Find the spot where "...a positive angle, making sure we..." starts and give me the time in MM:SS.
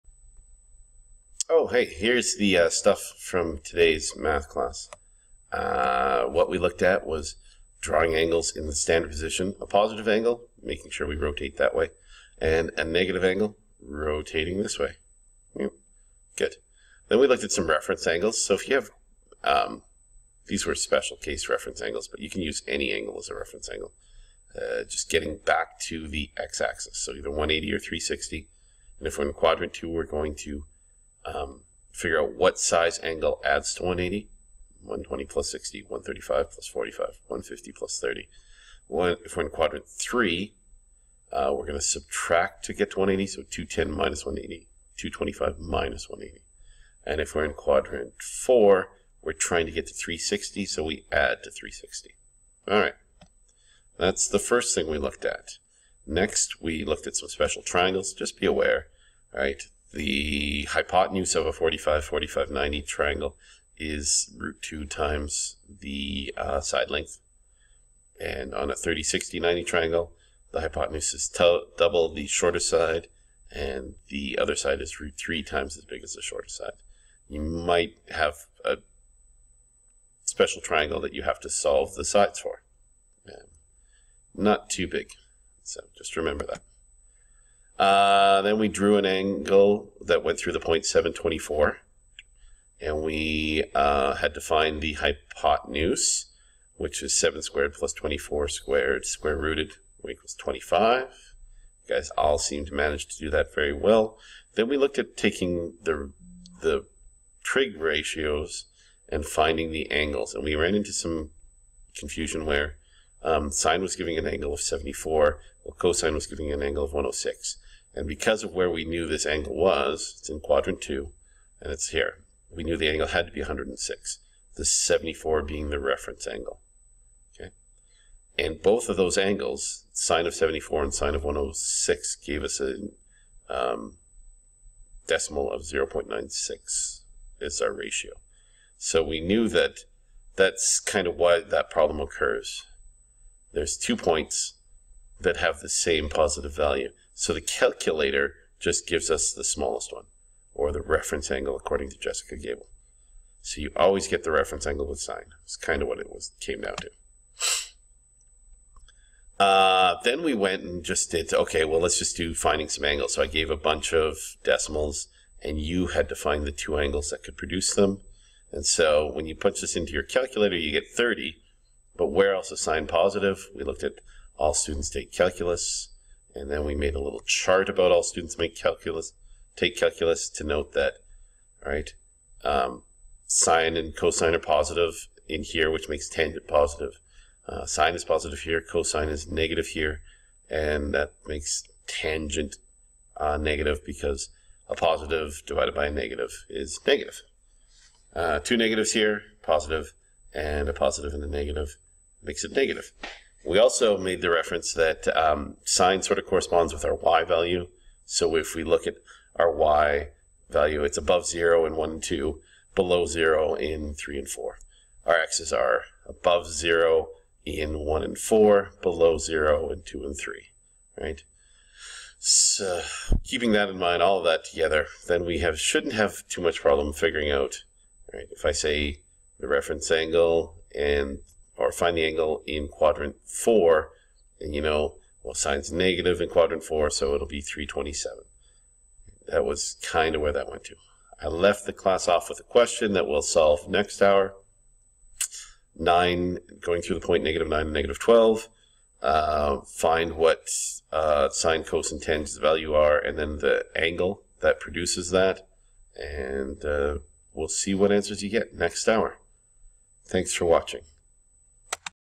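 00:09.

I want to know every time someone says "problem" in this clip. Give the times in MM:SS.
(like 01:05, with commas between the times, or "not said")
02:21, 03:46.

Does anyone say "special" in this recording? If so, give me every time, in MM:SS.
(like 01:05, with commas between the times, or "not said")
00:20, 00:57, 01:20.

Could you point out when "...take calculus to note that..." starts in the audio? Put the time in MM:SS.
02:59.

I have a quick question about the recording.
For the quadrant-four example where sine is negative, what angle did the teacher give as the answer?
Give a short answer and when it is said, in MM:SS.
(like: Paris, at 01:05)
327, at 03:57.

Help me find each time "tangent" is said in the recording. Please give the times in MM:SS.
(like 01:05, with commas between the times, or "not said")
03:06, 03:11, 04:12.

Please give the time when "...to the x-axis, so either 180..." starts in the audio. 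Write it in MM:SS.
00:25.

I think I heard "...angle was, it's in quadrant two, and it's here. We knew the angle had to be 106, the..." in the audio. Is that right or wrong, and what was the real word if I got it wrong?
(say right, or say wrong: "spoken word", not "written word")
right.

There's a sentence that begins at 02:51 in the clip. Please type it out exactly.
But where else is sine positive?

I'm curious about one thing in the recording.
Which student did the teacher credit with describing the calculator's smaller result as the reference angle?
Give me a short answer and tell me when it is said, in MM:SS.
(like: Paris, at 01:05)
Jessica Gable, at 02:31.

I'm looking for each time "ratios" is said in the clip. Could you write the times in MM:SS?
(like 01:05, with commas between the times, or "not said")
01:47, 02:17.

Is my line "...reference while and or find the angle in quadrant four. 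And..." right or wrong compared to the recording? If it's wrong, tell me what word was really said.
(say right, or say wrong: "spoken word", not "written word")
wrong: "angle", not "while".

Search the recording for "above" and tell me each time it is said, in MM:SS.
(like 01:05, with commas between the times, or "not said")
03:30, 03:36.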